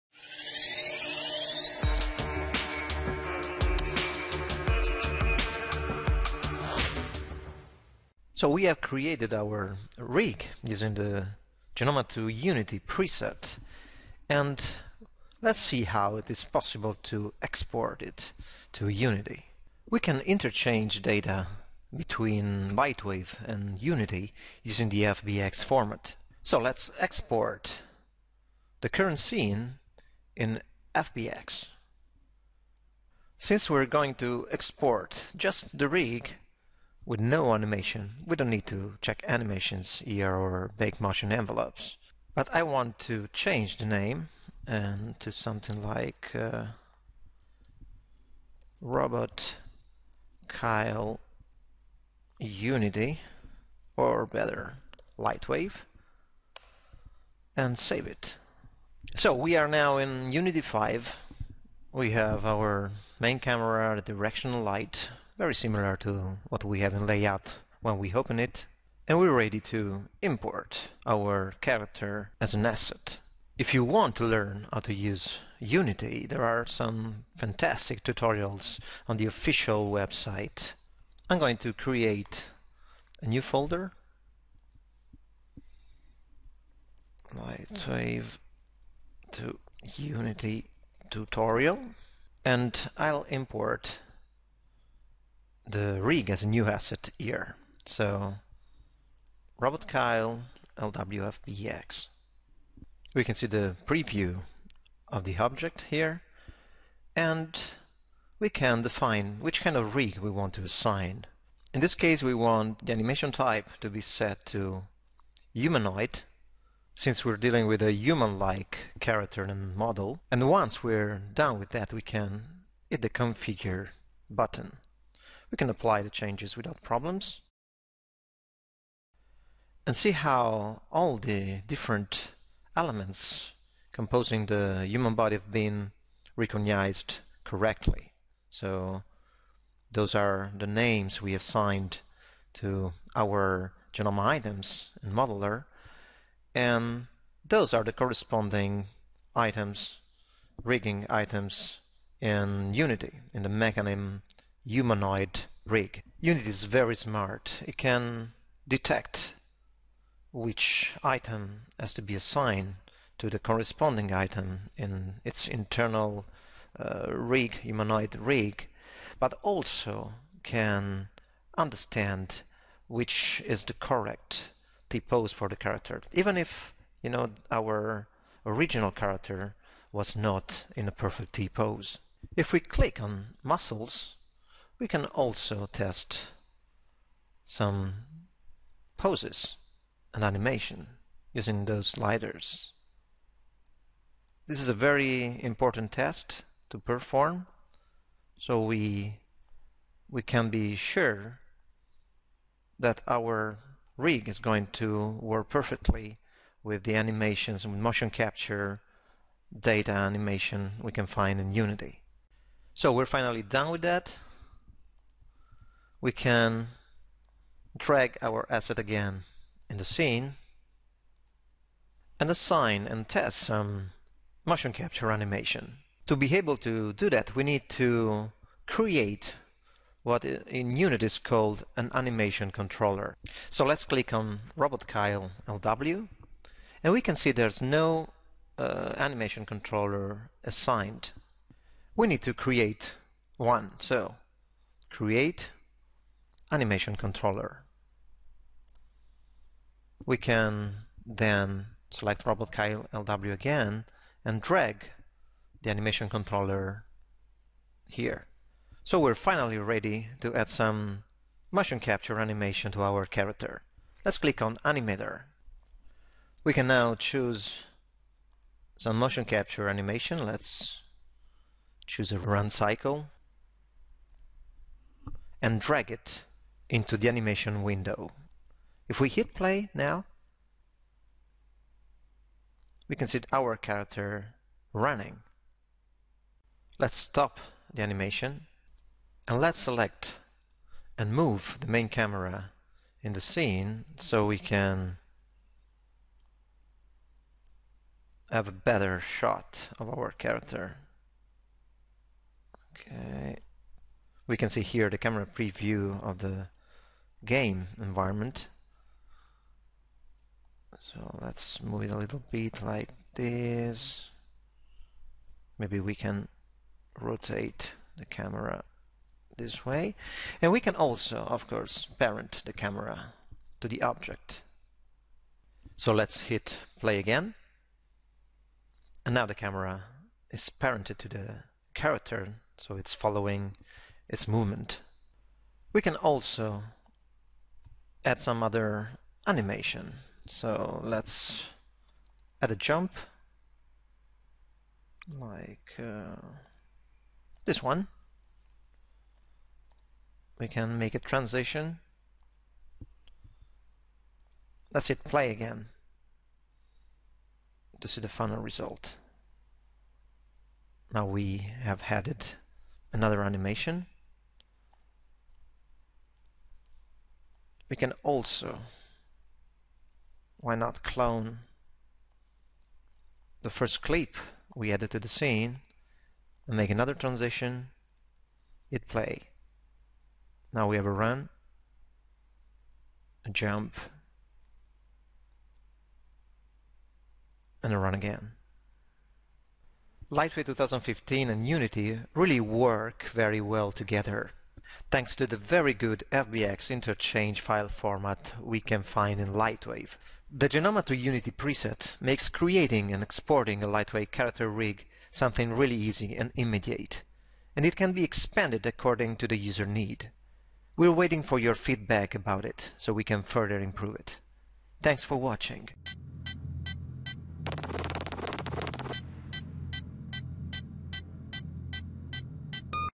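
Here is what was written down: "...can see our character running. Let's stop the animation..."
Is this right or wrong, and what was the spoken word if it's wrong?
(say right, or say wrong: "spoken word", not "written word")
right.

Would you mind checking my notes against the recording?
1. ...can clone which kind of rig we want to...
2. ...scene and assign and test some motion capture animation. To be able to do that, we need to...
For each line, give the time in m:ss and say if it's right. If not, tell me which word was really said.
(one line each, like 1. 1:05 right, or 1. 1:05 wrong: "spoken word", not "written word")
1. 1:48 wrong: "define", not "clone"
2. 3:39 right.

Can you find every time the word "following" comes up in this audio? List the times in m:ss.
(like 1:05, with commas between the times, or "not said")
5:32.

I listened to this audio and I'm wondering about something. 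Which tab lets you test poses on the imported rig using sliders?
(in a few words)
Muscles.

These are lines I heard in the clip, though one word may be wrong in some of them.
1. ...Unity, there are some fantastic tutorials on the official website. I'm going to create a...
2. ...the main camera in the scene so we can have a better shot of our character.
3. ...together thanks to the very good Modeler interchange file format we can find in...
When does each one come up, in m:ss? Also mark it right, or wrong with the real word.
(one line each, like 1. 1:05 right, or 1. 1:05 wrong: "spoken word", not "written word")
1. 1:15 right
2. 4:51 right
3. 6:33 wrong: "FBX", not "Modeler".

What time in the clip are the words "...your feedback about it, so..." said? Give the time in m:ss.
6:51.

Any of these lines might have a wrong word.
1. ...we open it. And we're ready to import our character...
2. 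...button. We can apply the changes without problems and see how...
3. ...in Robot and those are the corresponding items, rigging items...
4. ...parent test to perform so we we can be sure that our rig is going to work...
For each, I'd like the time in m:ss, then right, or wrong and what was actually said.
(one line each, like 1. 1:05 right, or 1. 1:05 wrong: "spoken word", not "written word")
1. 1:07 right
2. 2:04 right
3. 2:25 wrong: "Modeler", not "Robot"
4. 3:15 wrong: "important", not "parent".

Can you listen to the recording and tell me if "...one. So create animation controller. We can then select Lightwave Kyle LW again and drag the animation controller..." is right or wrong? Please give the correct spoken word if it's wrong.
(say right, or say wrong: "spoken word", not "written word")
wrong: "Robot", not "Lightwave".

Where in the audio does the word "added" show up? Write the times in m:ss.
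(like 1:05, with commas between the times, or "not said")
6:01, 6:14.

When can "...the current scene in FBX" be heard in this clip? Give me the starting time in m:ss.
0:28.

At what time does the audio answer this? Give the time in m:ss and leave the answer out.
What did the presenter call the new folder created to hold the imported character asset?
1:27.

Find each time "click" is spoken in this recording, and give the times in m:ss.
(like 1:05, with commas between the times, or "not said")
3:02, 3:53, 4:24.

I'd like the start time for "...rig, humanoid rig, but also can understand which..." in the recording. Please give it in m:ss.
2:47.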